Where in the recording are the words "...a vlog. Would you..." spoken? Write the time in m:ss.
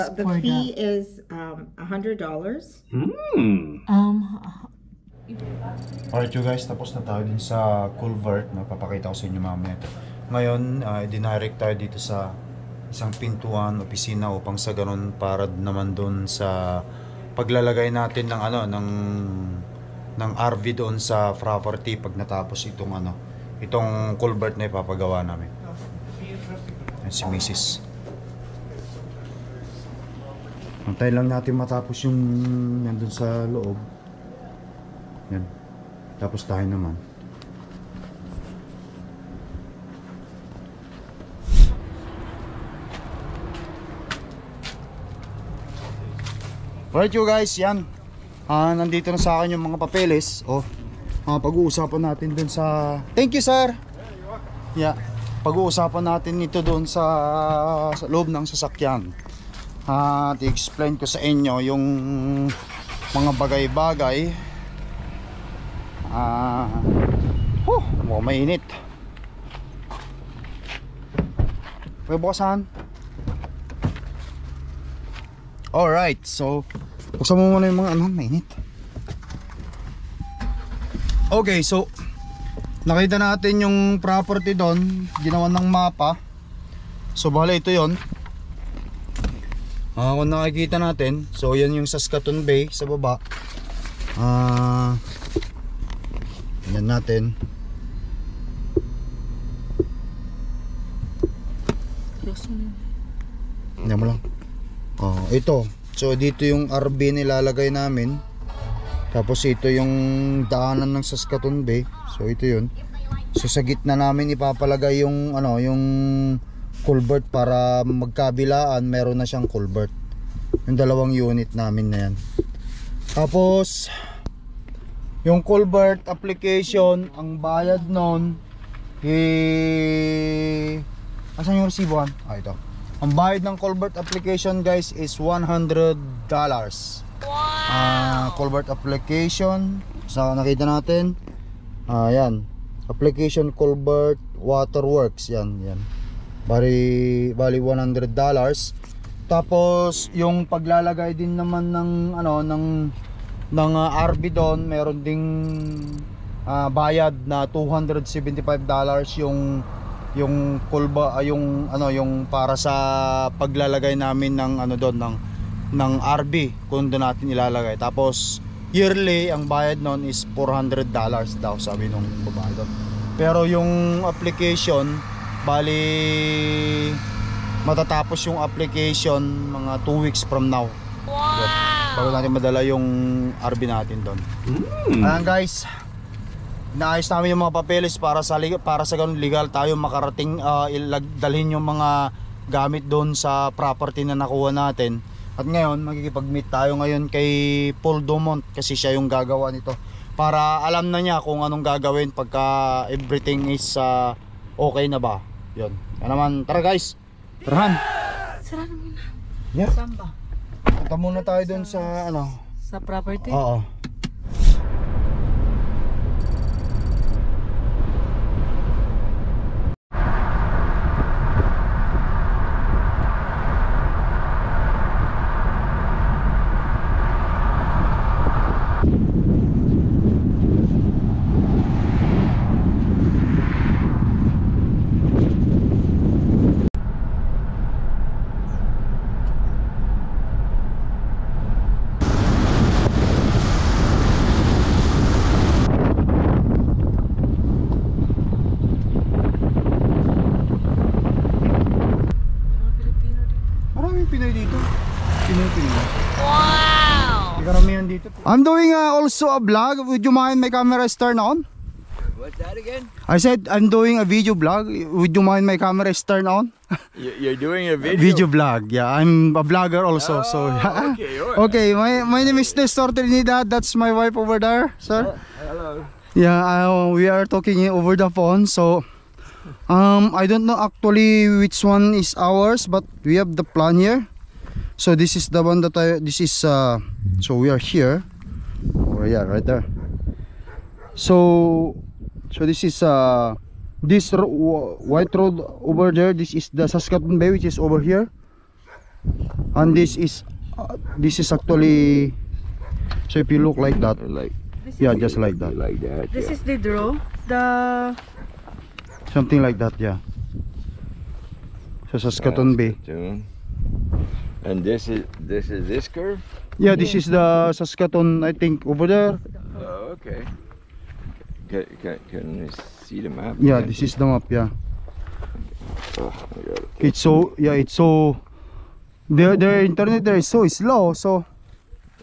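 4:19.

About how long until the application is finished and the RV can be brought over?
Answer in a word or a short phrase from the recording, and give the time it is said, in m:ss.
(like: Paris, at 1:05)
2 weeks, at 2:59.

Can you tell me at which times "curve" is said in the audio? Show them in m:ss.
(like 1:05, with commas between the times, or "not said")
5:15.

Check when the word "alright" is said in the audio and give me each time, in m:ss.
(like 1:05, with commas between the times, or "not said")
0:06, 0:46, 1:15.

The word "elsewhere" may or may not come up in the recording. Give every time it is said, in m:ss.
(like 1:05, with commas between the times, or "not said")
not said.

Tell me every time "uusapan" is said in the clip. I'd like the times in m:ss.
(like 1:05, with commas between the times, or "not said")
0:51, 0:55.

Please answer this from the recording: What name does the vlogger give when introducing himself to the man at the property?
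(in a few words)
Nestor Trinidad.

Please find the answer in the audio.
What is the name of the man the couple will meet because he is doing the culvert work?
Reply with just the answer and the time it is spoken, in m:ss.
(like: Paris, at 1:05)
Paul Dumont, at 3:17.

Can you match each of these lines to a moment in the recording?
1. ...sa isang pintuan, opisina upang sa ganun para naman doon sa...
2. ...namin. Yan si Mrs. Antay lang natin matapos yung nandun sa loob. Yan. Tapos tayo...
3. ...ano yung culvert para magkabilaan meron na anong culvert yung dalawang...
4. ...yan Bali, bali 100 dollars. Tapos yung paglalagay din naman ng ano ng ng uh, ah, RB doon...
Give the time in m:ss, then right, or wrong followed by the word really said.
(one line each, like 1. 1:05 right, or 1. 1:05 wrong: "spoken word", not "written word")
1. 0:11 right
2. 0:25 right
3. 1:55 wrong: "siyang", not "anong"
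4. 2:25 right.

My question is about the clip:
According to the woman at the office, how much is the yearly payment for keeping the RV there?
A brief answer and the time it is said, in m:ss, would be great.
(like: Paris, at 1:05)
$400, at 2:50.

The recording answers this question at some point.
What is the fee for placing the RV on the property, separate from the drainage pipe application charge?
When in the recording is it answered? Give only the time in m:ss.
2:37.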